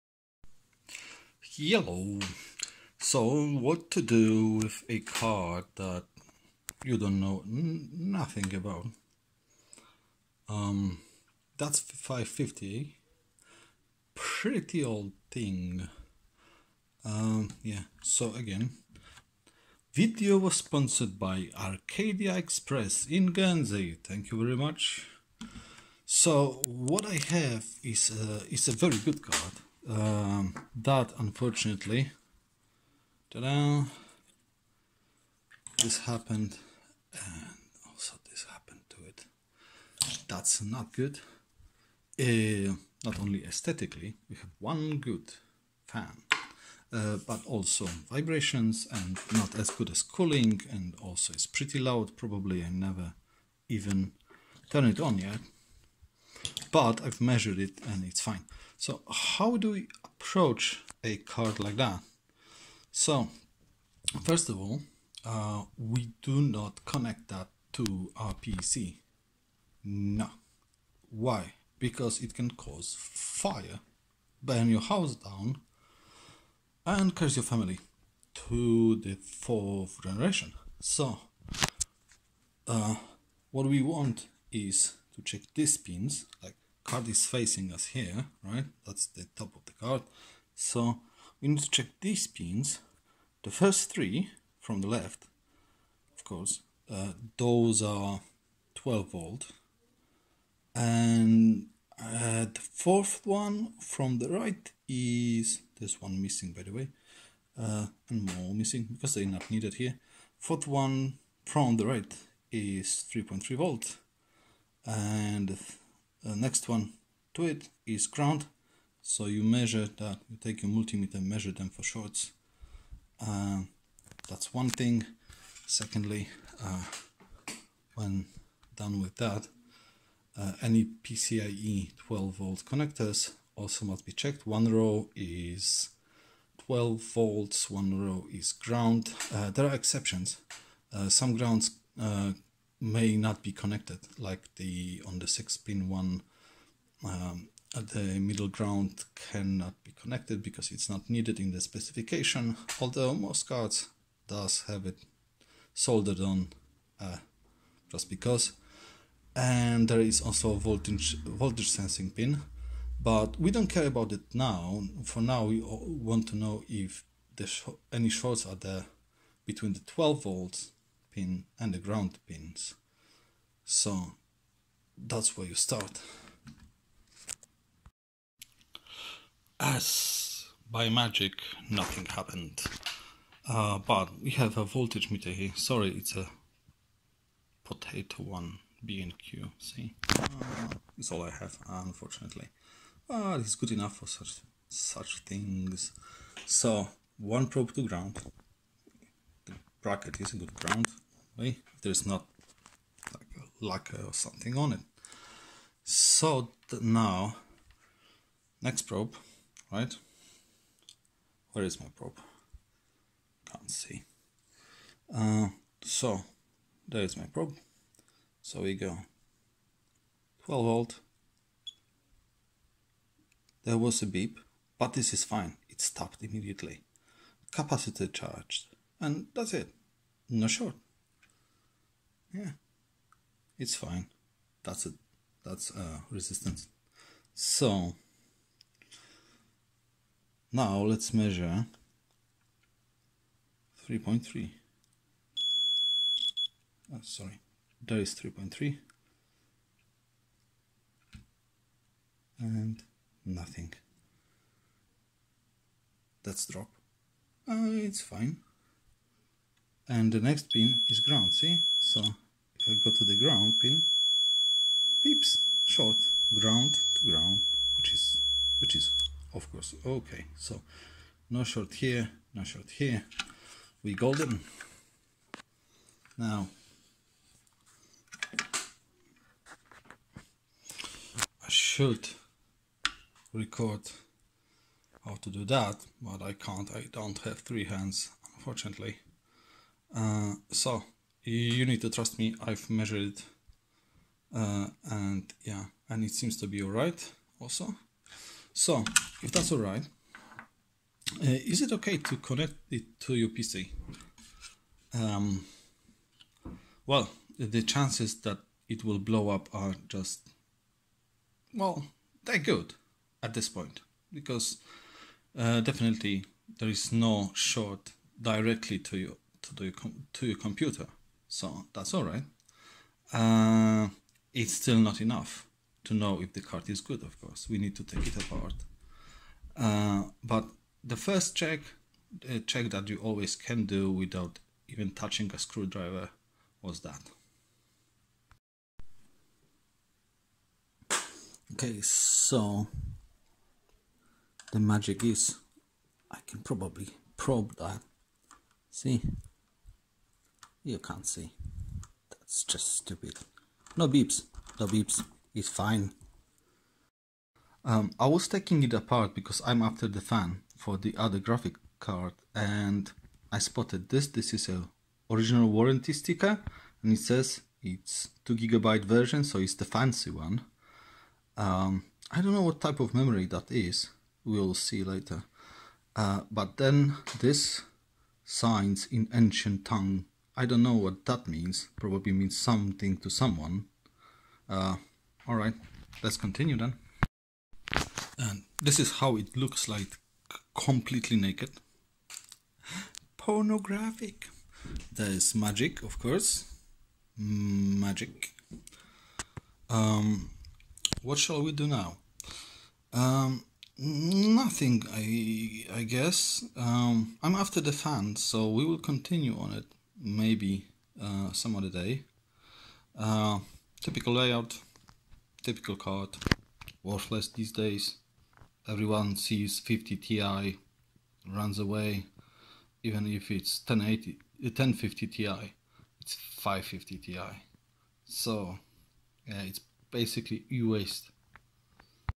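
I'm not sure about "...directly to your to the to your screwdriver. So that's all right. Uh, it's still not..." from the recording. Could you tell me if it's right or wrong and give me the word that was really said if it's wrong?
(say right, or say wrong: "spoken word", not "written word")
wrong: "computer", not "screwdriver".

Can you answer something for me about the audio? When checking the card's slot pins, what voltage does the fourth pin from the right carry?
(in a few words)
3.3 volt.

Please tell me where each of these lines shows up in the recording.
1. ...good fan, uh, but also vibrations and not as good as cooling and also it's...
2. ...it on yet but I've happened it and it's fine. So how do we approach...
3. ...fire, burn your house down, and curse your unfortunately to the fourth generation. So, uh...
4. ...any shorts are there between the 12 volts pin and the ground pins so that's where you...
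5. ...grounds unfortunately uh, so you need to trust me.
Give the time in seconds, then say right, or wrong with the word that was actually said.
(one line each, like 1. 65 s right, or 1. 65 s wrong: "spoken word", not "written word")
1. 44 s right
2. 54 s wrong: "measured", not "happened"
3. 72 s wrong: "family", not "unfortunately"
4. 167 s right
5. 287 s wrong: "hands", not "grounds".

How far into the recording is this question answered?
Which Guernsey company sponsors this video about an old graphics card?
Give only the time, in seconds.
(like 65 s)
21 s.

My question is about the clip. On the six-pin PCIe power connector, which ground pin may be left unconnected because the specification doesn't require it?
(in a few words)
The middle ground.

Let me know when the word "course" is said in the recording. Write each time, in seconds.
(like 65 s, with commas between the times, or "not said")
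96 s, 269 s, 327 s, 395 s.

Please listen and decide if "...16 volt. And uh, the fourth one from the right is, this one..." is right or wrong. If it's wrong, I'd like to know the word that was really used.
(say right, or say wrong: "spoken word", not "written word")
wrong: "12", not "16".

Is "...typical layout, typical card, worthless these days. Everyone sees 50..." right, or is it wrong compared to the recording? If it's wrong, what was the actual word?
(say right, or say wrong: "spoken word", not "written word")
right.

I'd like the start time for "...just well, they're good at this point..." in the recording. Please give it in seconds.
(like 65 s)
309 s.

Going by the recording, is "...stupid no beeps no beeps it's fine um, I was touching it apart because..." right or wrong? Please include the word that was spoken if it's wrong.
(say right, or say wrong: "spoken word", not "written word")
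wrong: "taking", not "touching".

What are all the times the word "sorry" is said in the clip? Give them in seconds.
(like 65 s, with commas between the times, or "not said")
185 s, 247 s.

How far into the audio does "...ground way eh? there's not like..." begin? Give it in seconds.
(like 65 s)
200 s.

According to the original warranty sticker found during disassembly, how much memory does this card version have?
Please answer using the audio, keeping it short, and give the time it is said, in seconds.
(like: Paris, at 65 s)
2 gigabytes, at 368 s.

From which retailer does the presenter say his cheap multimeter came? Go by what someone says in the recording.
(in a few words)
B&Q.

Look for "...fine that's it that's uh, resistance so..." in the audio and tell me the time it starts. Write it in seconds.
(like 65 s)
233 s.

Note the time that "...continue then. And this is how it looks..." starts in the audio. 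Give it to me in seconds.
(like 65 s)
386 s.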